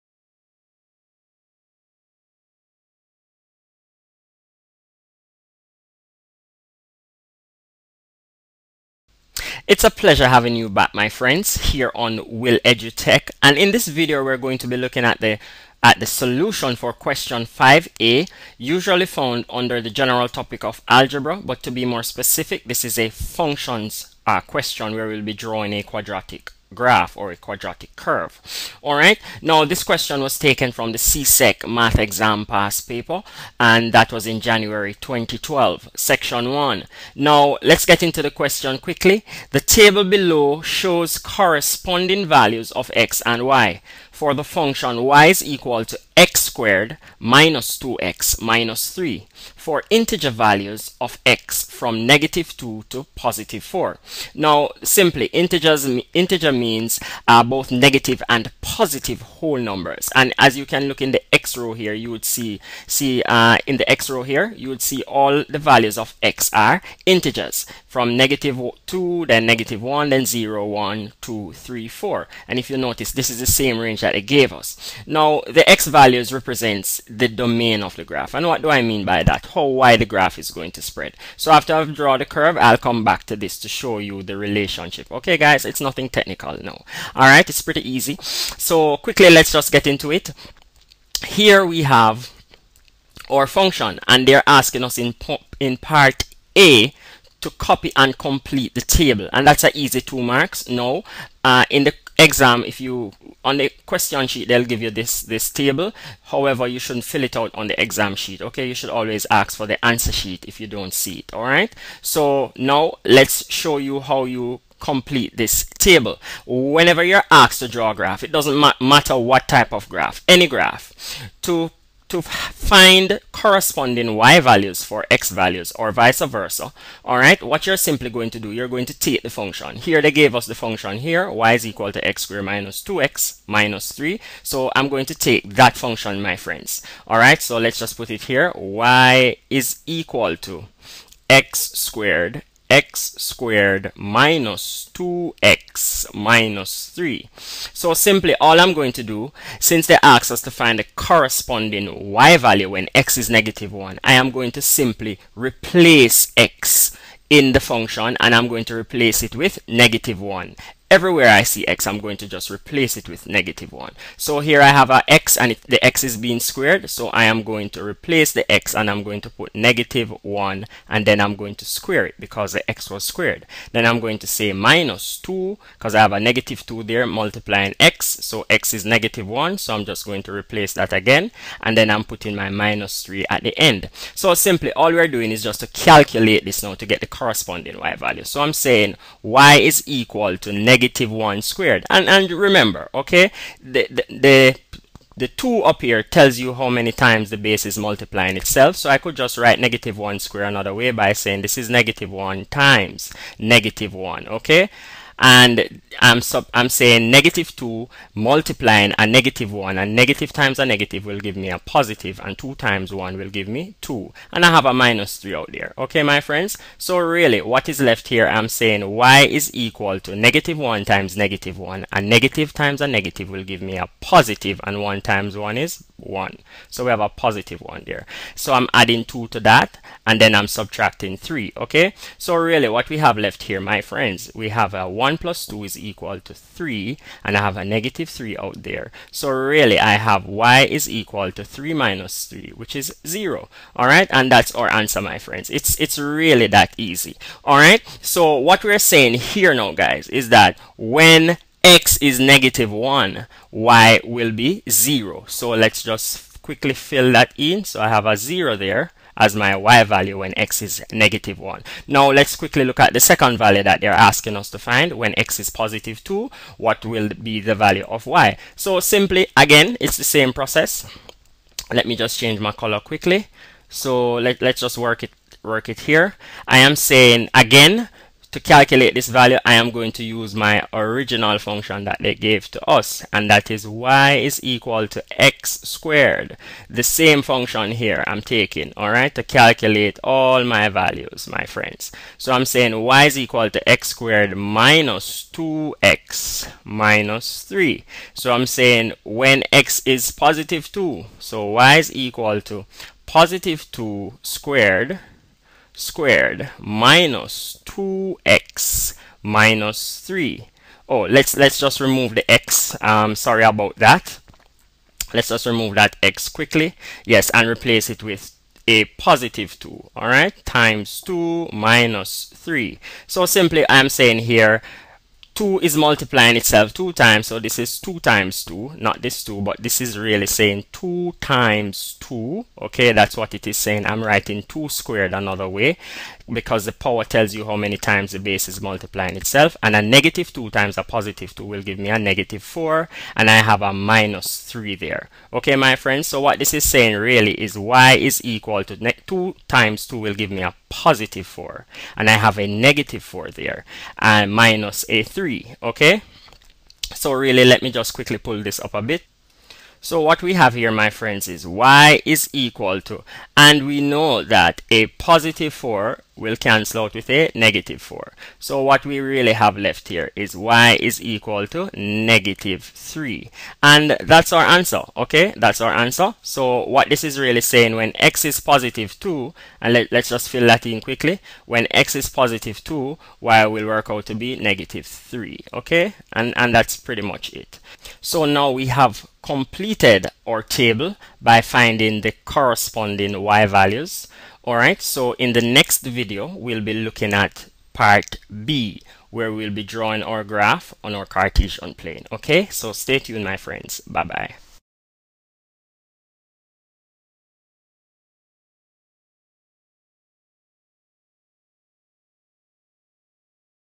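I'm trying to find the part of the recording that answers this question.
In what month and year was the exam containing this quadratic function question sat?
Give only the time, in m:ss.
0:34.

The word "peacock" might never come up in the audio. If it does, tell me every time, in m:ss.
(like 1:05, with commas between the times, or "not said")
not said.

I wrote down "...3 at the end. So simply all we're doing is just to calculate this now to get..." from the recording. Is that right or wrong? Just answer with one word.
right.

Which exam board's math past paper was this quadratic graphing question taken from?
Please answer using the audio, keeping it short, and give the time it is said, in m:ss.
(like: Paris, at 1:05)
CSEC, at 0:30.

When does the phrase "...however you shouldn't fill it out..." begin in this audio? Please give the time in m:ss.
1:46.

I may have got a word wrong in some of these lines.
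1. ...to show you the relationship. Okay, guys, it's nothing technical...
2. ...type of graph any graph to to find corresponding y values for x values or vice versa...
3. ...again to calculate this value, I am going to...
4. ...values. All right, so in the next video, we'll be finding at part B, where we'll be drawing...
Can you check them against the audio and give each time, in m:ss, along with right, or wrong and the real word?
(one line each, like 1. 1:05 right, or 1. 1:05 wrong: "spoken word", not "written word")
1. 1:23 right
2. 1:59 right
3. 4:37 right
4. 6:33 wrong: "looking", not "finding".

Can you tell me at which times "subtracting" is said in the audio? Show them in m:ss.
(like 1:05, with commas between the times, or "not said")
3:50.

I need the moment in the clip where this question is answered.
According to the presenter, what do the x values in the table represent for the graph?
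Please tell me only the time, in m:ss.
1:17.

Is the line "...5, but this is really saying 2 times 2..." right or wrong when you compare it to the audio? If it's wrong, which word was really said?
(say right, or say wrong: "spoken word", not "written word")
wrong: "2", not "5".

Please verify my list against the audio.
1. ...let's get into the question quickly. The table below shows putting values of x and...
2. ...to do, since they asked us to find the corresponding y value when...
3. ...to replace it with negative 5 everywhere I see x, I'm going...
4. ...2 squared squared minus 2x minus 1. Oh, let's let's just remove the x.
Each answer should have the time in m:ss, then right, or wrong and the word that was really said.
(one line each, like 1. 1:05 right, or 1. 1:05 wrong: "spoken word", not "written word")
1. 0:37 wrong: "corresponding", not "putting"
2. 2:28 right
3. 2:38 wrong: "1", not "5"
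4. 5:03 wrong: "3", not "1".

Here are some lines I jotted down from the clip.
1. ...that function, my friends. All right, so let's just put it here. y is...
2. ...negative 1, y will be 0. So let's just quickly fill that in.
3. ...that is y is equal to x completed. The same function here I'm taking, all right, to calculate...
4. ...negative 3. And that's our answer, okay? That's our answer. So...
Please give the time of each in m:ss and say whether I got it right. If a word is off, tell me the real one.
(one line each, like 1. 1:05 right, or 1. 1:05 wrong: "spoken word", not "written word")
1. 2:15 right
2. 4:12 right
3. 4:43 wrong: "squared", not "completed"
4. 6:11 right.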